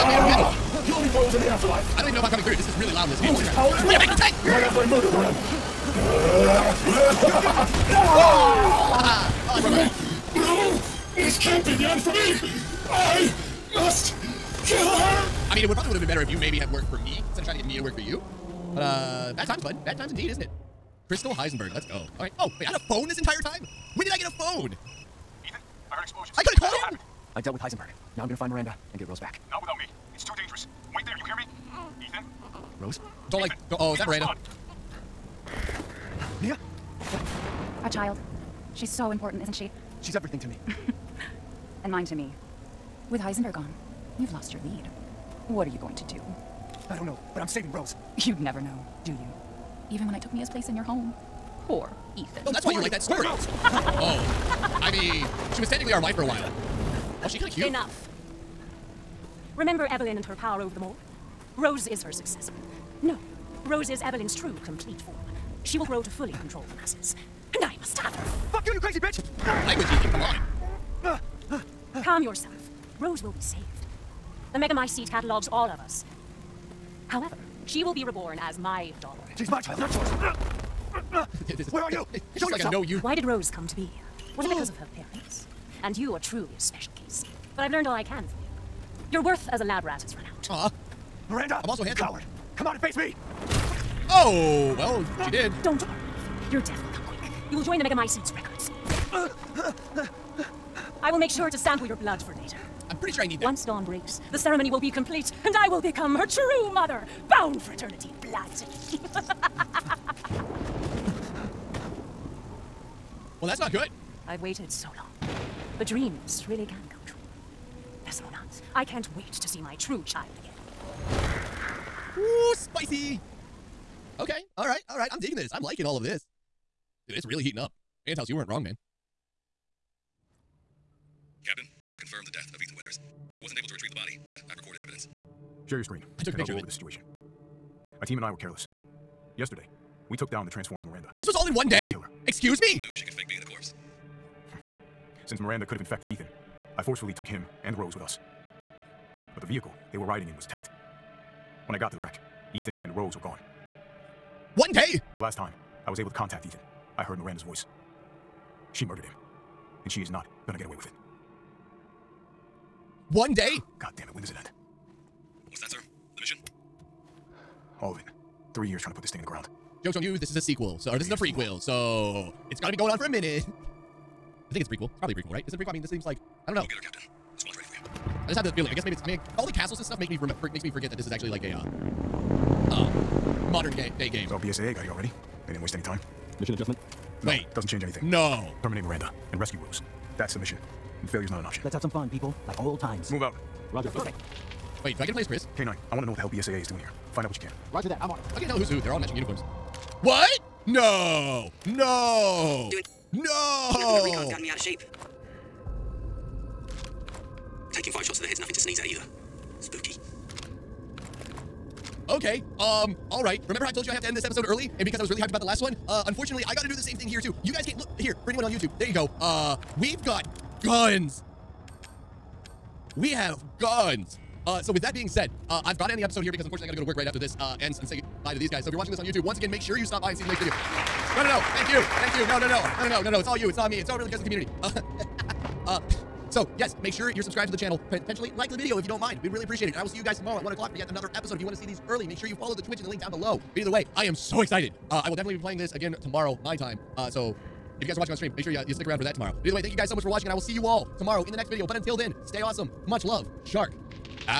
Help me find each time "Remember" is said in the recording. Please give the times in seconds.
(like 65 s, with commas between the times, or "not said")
59 s, 213 s.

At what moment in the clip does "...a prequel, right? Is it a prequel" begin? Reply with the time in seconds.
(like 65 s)
175 s.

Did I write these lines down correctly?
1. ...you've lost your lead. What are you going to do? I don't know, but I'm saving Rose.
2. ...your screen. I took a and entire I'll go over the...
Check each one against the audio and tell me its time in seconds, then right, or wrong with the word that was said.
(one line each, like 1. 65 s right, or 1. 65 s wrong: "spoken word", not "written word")
1. 44 s right
2. 135 s wrong: "picture", not "entire".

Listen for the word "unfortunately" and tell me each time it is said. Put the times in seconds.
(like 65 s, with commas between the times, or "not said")
216 s, 226 s.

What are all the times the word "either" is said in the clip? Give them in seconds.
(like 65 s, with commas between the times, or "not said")
208 s, 243 s, 249 s.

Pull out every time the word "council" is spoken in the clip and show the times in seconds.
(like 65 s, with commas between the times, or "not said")
not said.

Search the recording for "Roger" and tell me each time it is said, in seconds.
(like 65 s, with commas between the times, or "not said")
193 s, 197 s.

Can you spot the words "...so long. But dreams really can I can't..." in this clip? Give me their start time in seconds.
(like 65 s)
114 s.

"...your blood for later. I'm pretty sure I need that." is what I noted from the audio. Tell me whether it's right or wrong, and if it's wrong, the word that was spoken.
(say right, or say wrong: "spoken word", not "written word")
right.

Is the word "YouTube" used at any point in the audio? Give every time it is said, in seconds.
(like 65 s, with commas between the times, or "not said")
218 s, 229 s.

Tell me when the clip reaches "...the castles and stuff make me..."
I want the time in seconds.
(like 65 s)
179 s.